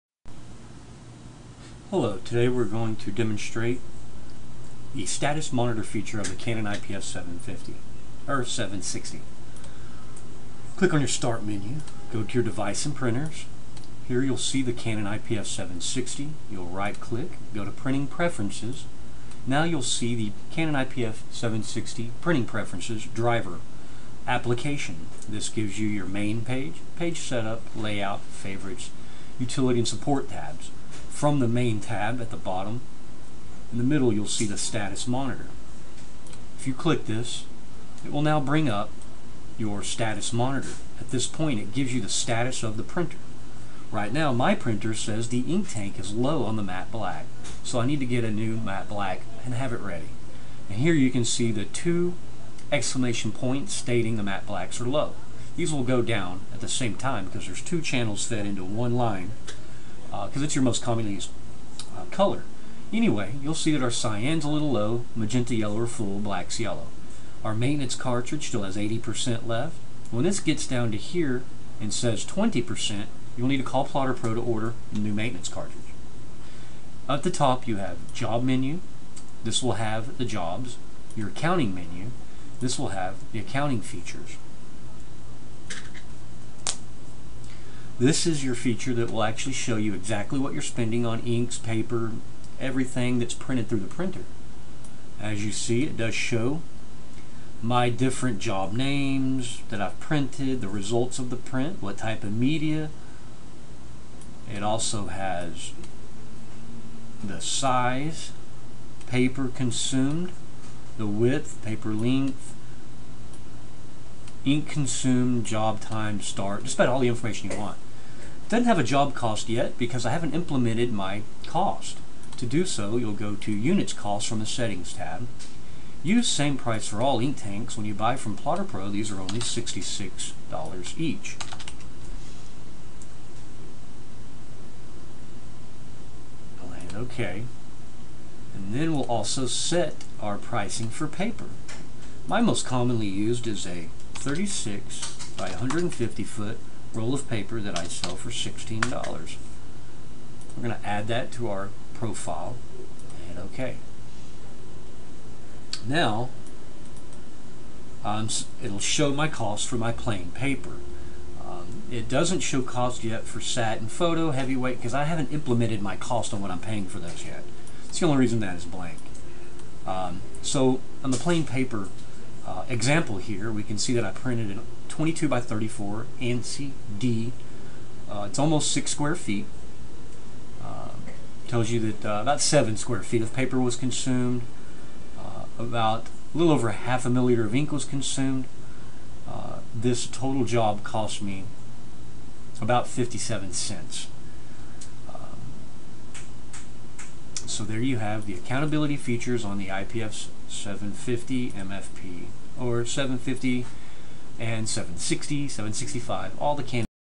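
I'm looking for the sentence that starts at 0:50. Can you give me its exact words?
And here you can see the two exclamation points stating the matte blacks are low.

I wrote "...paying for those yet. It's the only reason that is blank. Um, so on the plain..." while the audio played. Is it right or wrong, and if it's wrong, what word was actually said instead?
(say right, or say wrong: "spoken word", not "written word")
right.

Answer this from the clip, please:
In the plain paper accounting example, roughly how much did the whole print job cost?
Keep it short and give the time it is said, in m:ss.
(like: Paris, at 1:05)
57 cents, at 3:12.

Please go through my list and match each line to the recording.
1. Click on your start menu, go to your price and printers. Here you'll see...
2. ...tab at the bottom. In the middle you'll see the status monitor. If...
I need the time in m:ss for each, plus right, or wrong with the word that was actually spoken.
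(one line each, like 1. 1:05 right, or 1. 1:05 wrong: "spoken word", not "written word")
1. 0:10 wrong: "device", not "price"
2. 0:31 right.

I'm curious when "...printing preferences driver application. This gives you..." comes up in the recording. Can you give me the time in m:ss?
0:22.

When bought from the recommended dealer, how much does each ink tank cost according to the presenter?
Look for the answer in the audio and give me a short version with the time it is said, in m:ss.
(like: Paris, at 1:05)
$66, at 2:09.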